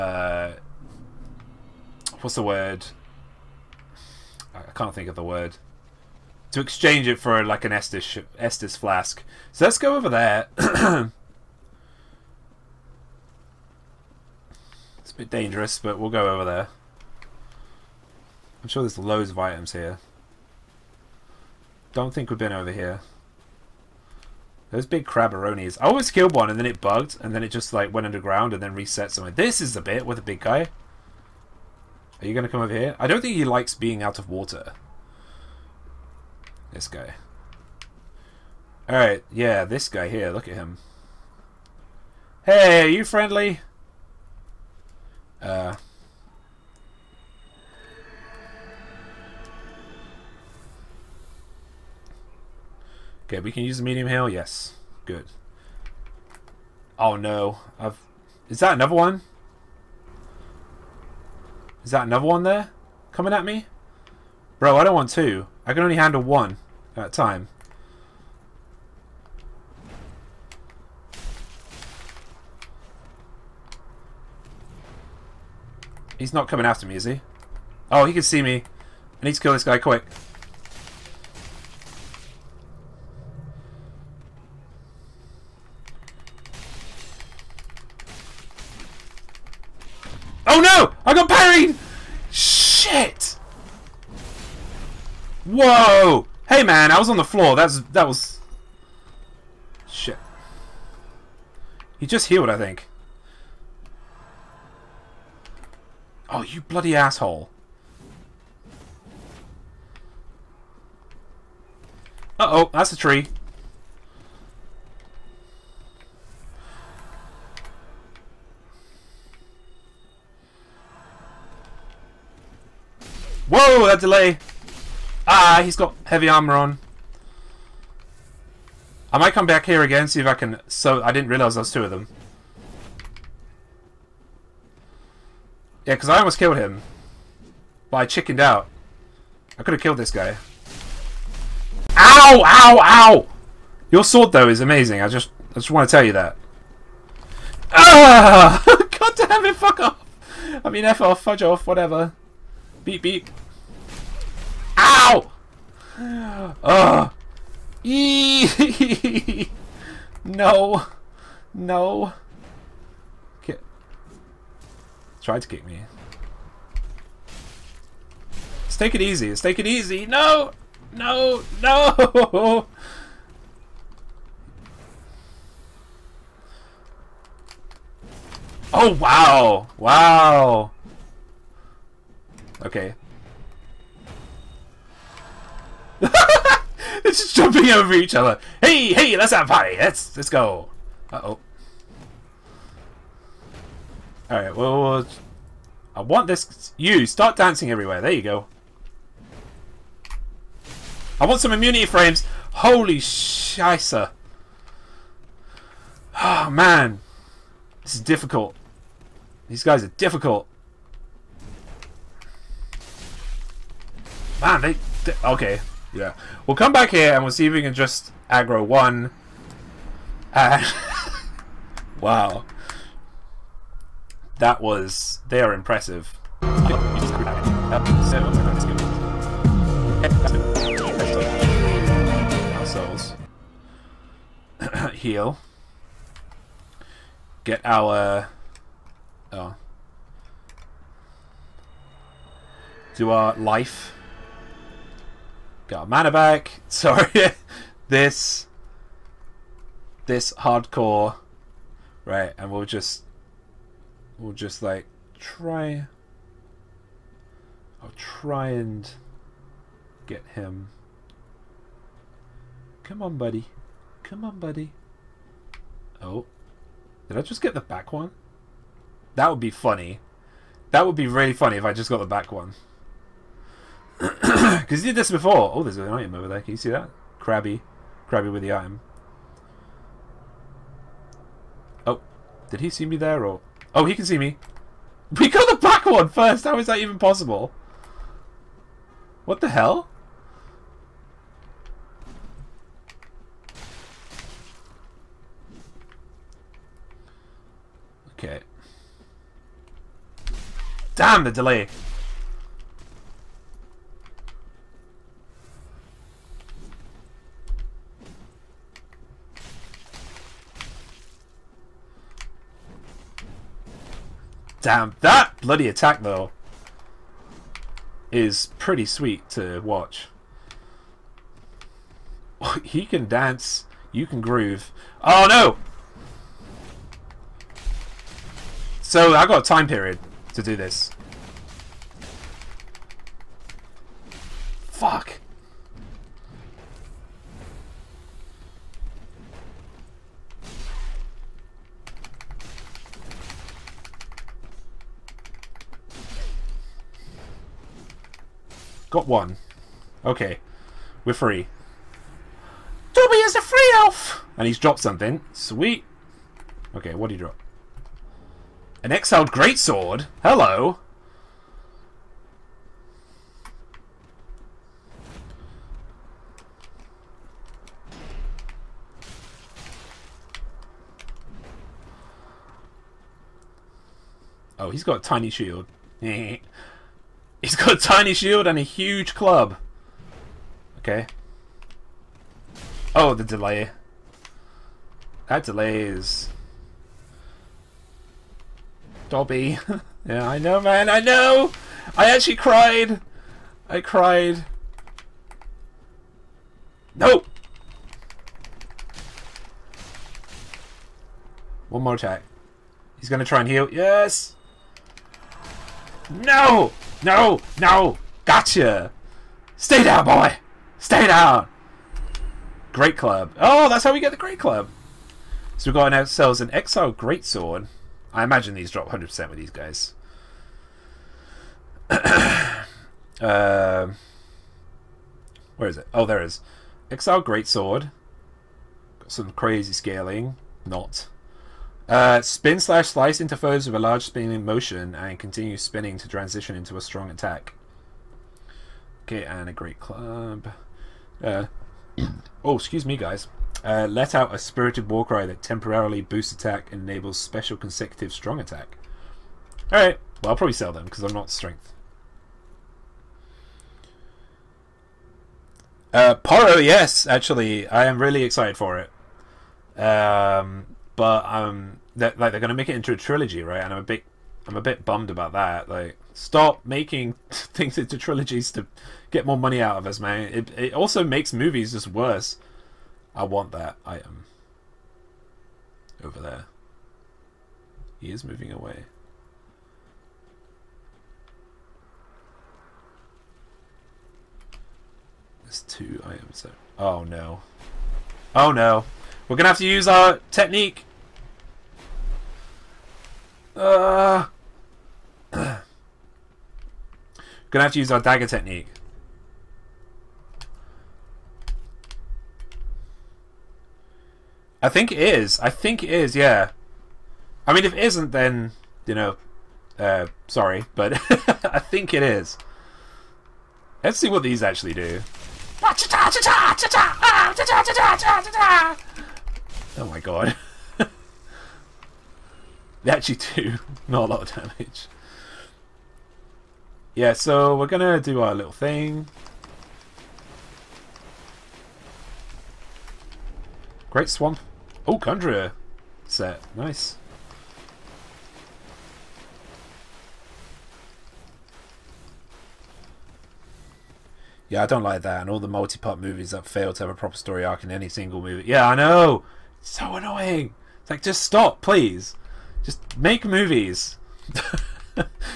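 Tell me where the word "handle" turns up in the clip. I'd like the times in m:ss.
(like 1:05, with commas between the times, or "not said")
1:05.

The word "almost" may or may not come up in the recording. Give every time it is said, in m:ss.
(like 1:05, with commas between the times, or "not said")
2:16.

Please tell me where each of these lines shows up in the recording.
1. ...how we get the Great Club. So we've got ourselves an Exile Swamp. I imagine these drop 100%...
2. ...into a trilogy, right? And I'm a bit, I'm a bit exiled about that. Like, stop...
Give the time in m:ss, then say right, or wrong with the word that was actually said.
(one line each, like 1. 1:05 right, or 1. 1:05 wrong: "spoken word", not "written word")
1. 6:53 wrong: "Greatsword", not "Swamp"
2. 7:42 wrong: "bummed", not "exiled".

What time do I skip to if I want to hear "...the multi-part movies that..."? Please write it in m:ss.
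9:05.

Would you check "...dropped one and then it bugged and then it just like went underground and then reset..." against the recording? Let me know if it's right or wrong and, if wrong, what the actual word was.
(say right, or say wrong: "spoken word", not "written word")
wrong: "killed", not "dropped".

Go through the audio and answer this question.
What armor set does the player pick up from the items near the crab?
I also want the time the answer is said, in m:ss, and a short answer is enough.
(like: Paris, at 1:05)
Chondria set, at 8:54.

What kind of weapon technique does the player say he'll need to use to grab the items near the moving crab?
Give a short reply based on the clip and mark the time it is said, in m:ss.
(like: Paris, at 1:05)
Dagger technique, at 8:17.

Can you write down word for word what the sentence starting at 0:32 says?
Are you going to come over here?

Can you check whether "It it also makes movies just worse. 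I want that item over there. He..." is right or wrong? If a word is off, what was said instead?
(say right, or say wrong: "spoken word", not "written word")
right.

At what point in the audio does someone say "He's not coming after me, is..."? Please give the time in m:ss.
1:16.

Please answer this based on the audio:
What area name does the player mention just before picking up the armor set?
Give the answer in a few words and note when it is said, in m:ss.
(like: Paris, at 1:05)
Great Swamp, at 8:53.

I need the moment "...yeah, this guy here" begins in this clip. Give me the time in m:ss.
0:39.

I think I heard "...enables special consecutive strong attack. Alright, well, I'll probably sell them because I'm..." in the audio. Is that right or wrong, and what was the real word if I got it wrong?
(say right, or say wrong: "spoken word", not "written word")
right.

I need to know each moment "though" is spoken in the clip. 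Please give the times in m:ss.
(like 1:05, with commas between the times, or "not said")
2:24, 5:16.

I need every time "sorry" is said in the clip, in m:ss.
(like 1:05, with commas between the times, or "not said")
4:06, 8:30.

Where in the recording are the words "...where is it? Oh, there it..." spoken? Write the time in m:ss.
7:05.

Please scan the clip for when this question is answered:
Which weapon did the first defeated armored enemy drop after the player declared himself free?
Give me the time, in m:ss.
5:58.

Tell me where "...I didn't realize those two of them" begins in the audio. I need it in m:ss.
2:11.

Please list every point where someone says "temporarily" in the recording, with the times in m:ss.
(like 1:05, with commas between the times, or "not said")
7:25.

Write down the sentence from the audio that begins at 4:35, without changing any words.
Oh, there's an item over there.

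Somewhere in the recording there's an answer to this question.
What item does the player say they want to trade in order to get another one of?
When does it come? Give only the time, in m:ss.
0:07.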